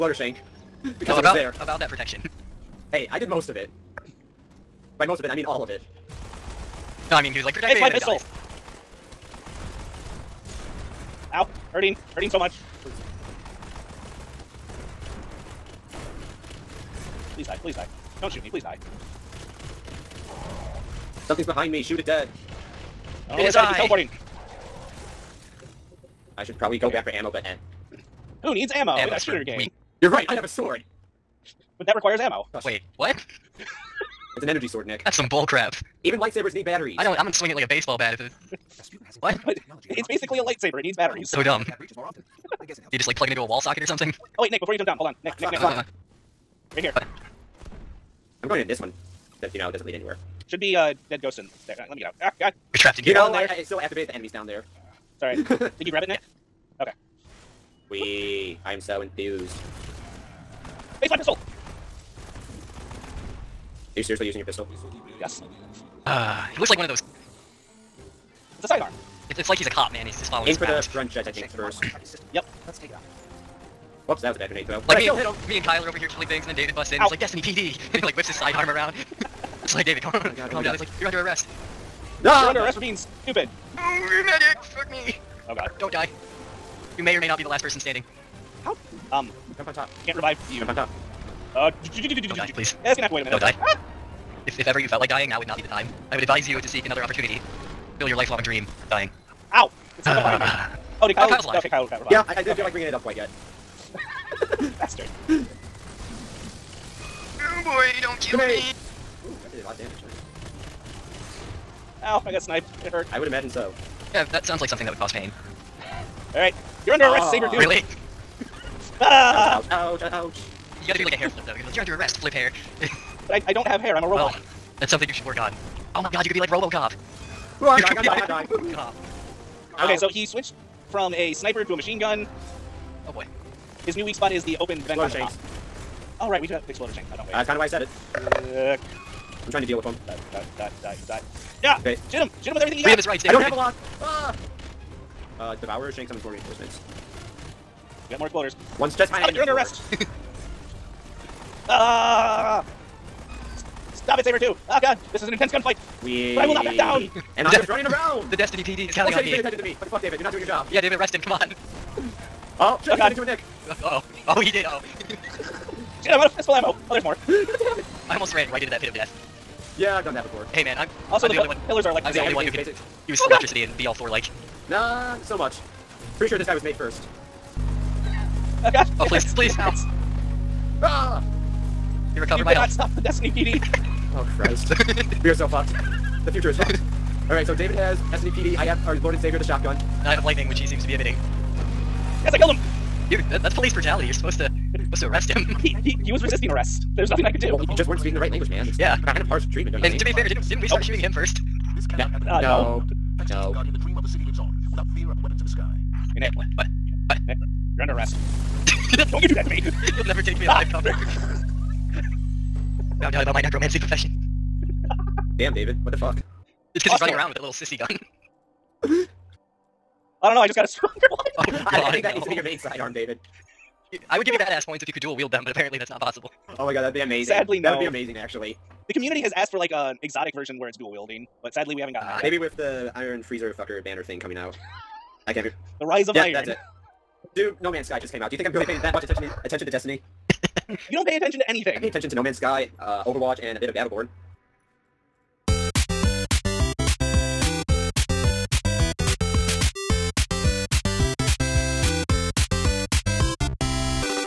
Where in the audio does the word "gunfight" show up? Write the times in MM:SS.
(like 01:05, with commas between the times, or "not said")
02:35.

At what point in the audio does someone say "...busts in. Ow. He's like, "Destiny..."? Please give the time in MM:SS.
01:16.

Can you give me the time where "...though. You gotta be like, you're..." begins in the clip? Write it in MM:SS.
02:01.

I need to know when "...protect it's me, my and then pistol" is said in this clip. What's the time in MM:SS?
00:07.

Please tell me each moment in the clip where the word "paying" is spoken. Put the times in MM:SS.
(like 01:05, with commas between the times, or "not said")
02:39, 03:58.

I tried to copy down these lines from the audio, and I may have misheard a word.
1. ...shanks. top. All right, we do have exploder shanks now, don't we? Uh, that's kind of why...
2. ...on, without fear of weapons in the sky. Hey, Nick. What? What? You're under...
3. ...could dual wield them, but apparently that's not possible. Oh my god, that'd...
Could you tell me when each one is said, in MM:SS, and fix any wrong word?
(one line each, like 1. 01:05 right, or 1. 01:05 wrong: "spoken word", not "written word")
1. 02:15 right
2. 03:24 right
3. 03:44 right.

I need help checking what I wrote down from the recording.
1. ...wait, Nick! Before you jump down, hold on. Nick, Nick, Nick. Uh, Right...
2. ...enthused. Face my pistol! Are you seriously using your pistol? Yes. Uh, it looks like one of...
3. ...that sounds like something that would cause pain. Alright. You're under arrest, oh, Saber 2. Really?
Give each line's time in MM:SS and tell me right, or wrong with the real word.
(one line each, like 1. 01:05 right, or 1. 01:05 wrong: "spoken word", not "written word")
1. 00:44 right
2. 00:59 right
3. 01:54 right.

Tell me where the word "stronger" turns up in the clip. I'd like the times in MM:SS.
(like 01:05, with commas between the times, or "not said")
03:40.